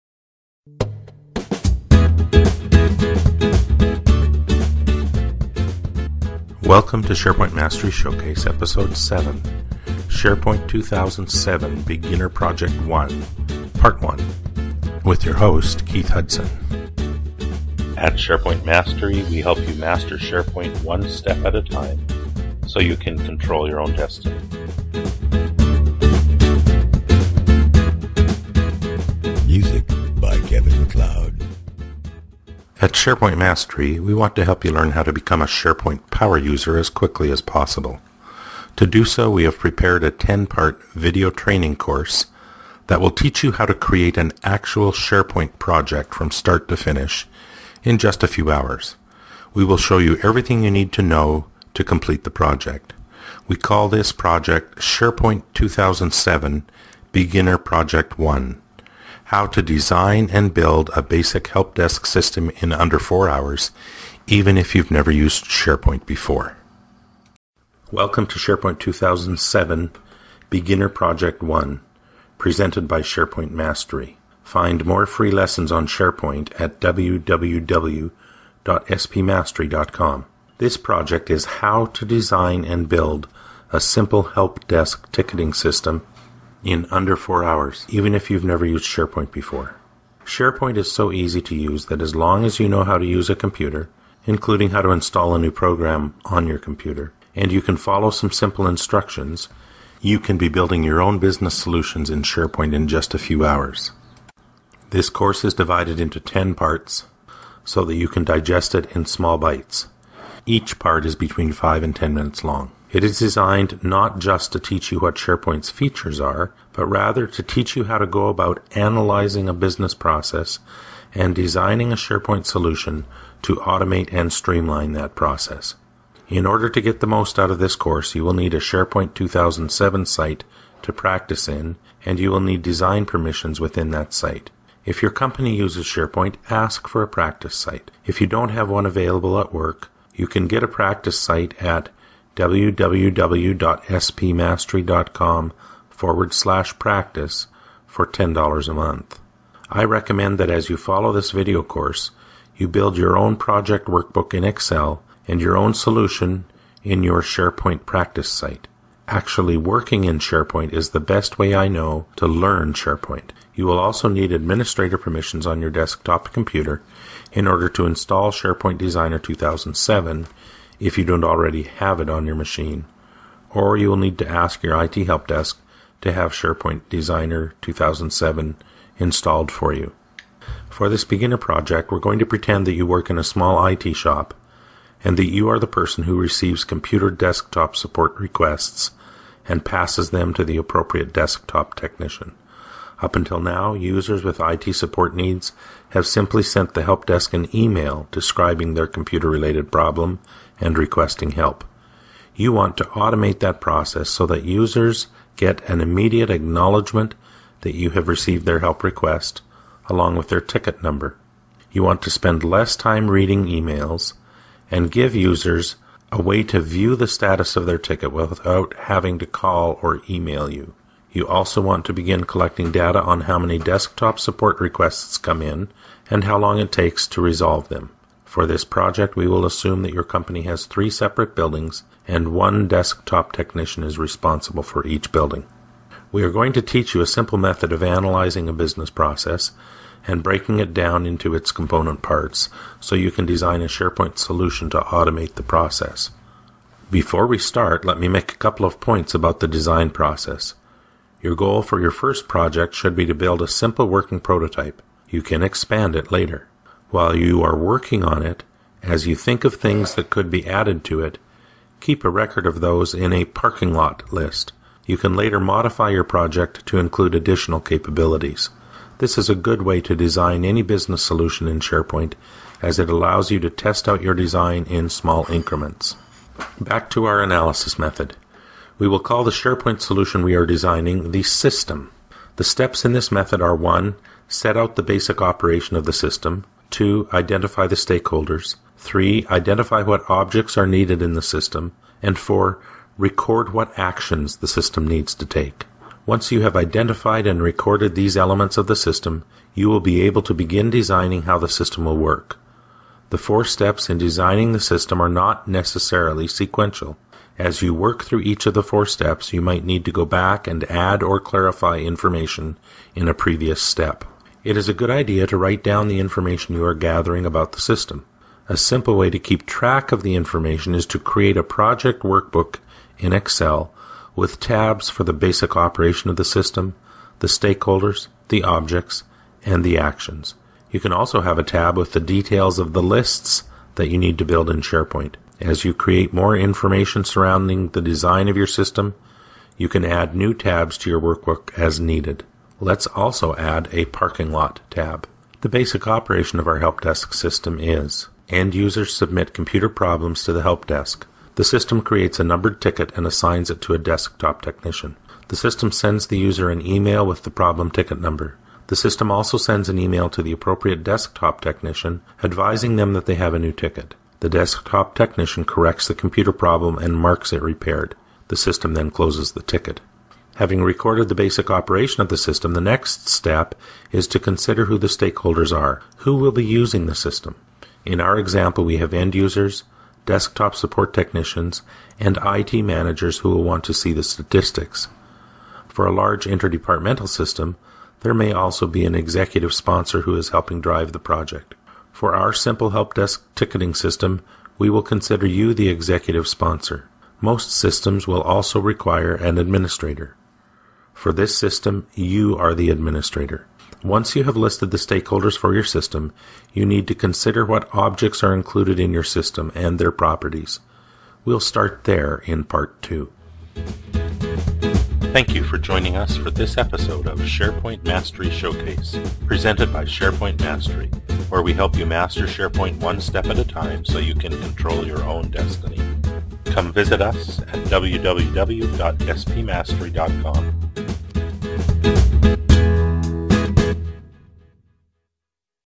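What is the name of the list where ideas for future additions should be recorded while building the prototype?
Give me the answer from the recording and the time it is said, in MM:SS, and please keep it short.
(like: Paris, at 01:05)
parking lot list, at 04:23.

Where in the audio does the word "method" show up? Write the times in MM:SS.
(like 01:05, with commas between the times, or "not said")
03:57, 04:37, 04:43.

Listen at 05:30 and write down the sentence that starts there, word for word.
You can also have a tab with the details of the lists that you need to build in SharePoint.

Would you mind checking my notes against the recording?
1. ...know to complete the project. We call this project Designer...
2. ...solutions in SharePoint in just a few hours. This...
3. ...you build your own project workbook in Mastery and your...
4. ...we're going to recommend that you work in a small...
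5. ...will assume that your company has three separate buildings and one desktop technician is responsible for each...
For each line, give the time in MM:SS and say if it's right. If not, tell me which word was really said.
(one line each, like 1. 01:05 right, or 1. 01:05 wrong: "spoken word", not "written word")
1. 00:51 wrong: "SharePoint", not "Designer"
2. 01:41 right
3. 02:32 wrong: "Excel", not "Mastery"
4. 03:01 wrong: "pretend", not "recommend"
5. 03:49 right.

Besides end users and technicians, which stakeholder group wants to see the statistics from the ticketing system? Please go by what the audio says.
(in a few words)
IT managers.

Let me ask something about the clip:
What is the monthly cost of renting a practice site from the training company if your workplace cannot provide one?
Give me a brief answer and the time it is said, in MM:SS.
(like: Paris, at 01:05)
$10, at 02:28.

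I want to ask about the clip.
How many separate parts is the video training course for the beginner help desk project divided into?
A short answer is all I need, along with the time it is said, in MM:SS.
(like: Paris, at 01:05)
10, at 00:40.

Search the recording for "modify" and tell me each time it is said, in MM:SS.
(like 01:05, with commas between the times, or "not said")
04:25.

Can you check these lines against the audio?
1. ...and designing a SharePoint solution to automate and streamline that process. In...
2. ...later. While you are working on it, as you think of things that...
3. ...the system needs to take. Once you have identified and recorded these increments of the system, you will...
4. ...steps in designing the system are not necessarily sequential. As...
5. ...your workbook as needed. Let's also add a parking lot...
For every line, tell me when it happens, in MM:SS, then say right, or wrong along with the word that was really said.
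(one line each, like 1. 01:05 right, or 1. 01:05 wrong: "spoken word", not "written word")
1. 02:01 right
2. 04:16 right
3. 04:54 wrong: "elements", not "increments"
4. 05:03 right
5. 05:40 right.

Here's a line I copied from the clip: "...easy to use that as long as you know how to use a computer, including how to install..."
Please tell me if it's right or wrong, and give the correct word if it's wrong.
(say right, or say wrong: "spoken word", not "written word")
right.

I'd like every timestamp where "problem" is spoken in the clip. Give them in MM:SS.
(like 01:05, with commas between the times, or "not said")
03:19, 05:49, 05:57, 06:06.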